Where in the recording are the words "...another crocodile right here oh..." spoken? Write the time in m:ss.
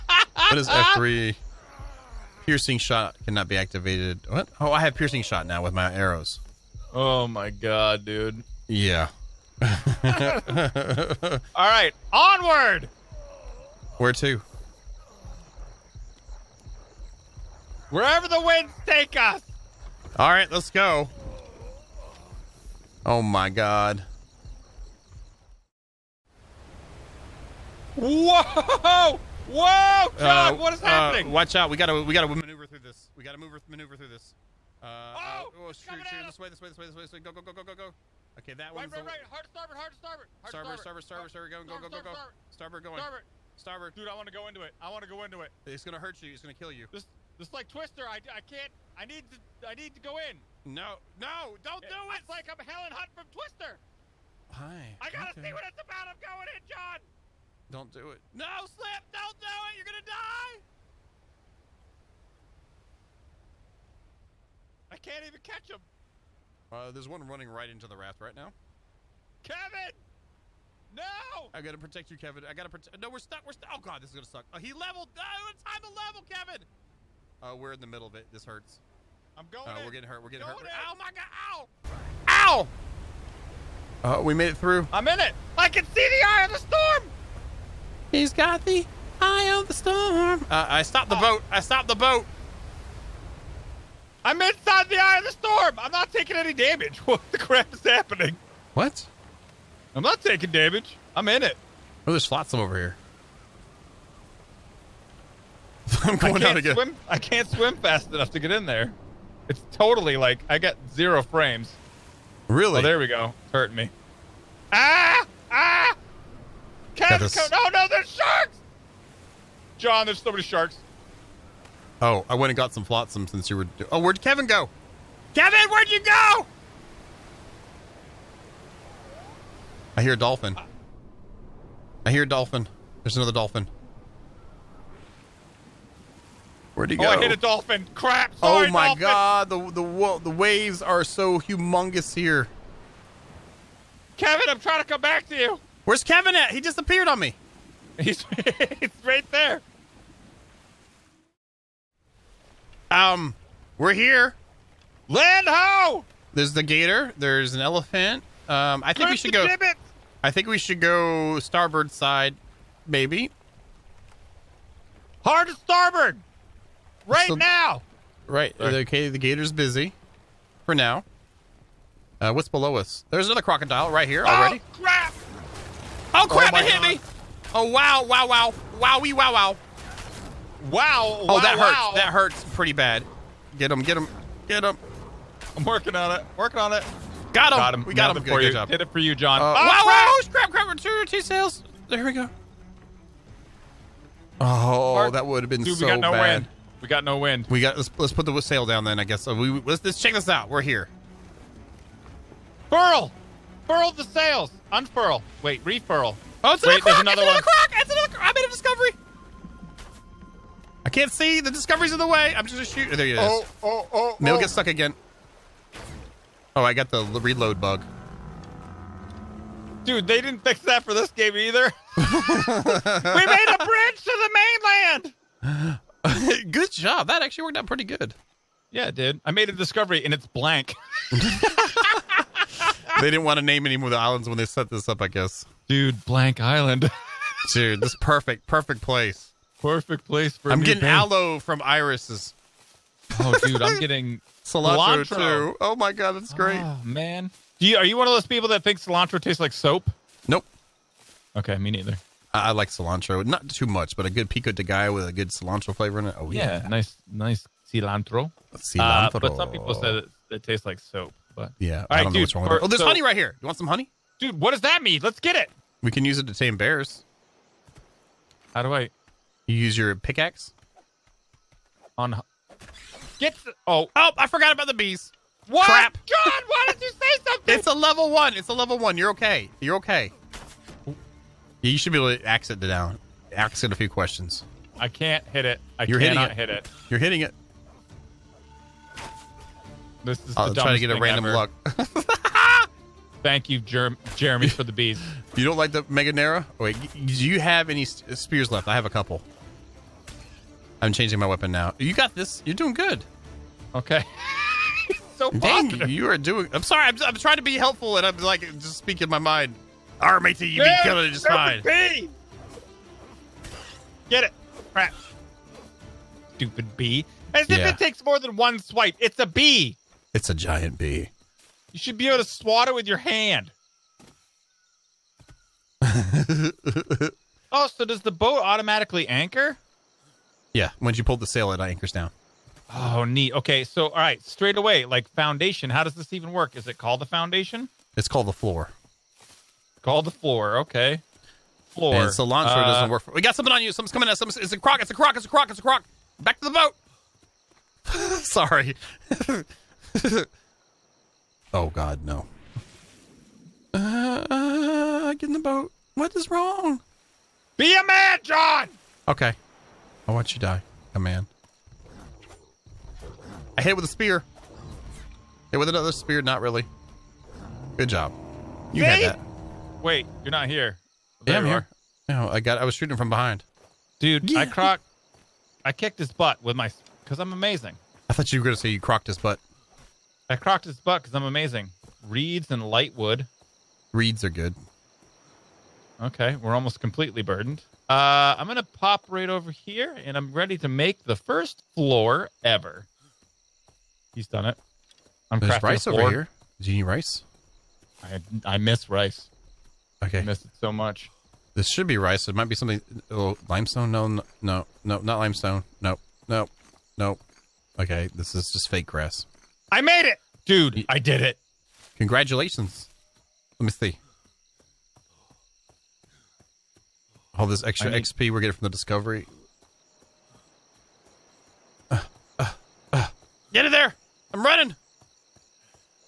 2:53.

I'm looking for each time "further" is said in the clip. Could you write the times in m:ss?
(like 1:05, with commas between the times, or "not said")
not said.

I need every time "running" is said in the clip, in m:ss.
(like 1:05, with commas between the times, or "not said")
1:07, 7:04.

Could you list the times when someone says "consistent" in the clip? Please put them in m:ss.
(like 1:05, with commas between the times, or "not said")
not said.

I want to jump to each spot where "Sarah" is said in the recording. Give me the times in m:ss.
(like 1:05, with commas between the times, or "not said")
not said.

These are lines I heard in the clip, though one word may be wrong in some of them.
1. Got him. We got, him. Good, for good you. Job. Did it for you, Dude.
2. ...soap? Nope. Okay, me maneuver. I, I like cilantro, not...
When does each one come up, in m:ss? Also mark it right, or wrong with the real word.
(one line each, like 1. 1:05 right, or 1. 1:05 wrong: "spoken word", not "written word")
1. 3:07 wrong: "John", not "Dude"
2. 4:09 wrong: "neither", not "maneuver".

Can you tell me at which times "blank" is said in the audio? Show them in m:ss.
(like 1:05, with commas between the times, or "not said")
3:50, 3:56.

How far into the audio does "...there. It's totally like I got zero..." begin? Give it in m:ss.
1:48.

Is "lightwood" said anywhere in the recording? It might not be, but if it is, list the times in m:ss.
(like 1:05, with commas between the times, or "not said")
6:22.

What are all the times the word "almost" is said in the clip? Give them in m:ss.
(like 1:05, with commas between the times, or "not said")
6:26.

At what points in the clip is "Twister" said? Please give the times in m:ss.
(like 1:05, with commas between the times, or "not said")
0:47, 0:53.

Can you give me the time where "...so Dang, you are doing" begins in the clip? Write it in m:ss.
5:05.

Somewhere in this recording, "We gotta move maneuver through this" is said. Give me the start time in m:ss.
0:33.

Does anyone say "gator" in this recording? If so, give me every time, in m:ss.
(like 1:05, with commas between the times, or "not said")
2:36, 2:49.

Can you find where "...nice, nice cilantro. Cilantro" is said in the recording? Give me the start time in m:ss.
4:16.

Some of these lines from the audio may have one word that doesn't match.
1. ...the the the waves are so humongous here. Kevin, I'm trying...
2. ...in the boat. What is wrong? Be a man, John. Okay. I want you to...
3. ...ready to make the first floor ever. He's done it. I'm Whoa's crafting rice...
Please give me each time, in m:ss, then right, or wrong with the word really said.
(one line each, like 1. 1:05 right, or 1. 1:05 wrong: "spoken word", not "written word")
1. 2:19 right
2. 5:55 right
3. 6:30 wrong: "There", not "Whoa".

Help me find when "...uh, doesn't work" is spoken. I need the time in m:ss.
5:42.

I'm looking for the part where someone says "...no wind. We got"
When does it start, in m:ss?
3:17.